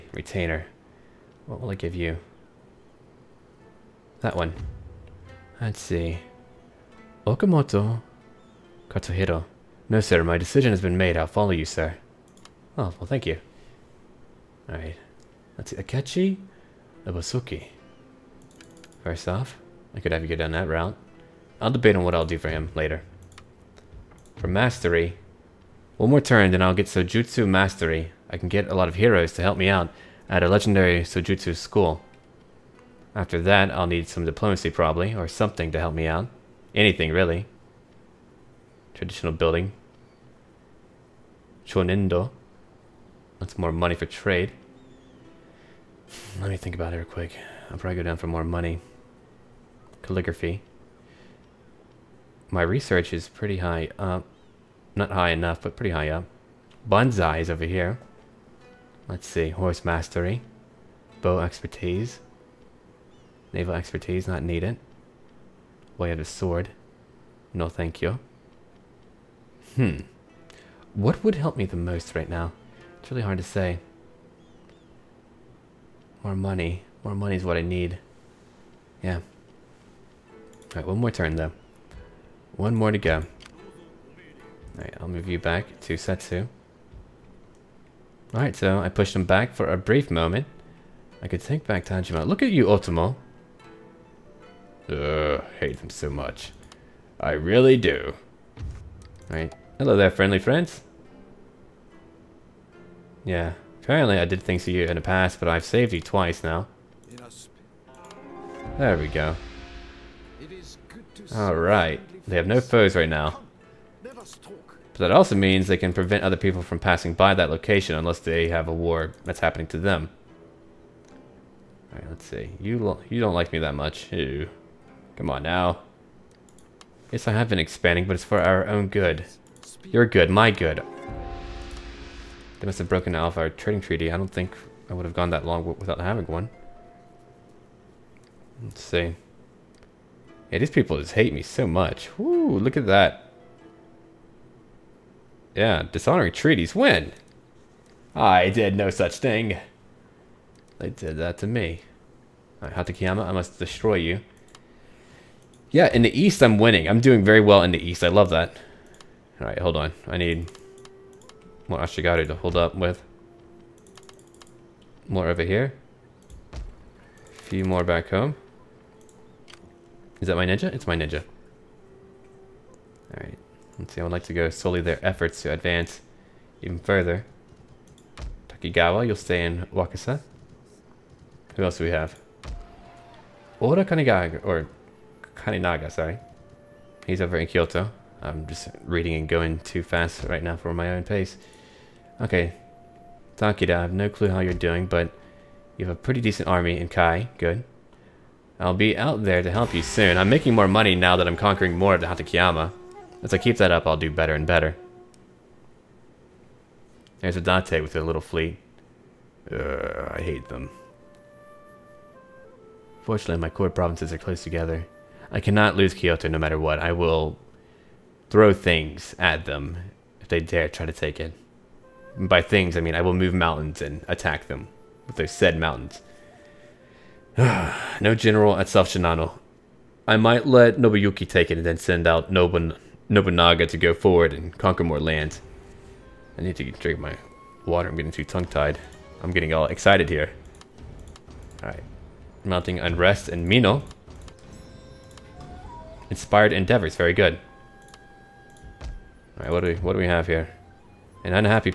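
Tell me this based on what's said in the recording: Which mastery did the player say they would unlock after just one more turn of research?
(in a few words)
Sojutsu Mastery.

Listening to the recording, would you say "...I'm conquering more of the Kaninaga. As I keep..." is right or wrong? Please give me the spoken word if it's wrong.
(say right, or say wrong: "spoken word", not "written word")
wrong: "Hatakeyama", not "Kaninaga".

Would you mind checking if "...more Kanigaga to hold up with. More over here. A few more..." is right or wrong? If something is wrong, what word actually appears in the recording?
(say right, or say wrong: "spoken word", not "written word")
wrong: "Ashigaru", not "Kanigaga".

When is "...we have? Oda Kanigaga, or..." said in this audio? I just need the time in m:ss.
3:01.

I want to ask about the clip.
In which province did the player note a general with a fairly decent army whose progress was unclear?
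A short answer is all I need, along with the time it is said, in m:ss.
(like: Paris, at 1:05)
Kai, at 3:16.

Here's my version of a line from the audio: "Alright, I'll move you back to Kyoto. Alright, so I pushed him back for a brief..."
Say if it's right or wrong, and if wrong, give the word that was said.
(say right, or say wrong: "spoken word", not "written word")
wrong: "Setsu", not "Kyoto".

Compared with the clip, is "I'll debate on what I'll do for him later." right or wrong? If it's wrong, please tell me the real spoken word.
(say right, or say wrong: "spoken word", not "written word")
right.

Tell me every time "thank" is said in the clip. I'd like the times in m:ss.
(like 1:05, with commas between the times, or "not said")
0:13, 1:07.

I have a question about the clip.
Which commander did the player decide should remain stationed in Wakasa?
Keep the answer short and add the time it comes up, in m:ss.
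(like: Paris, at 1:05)
Takigawa, at 2:58.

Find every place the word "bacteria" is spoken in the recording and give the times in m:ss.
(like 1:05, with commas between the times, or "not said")
not said.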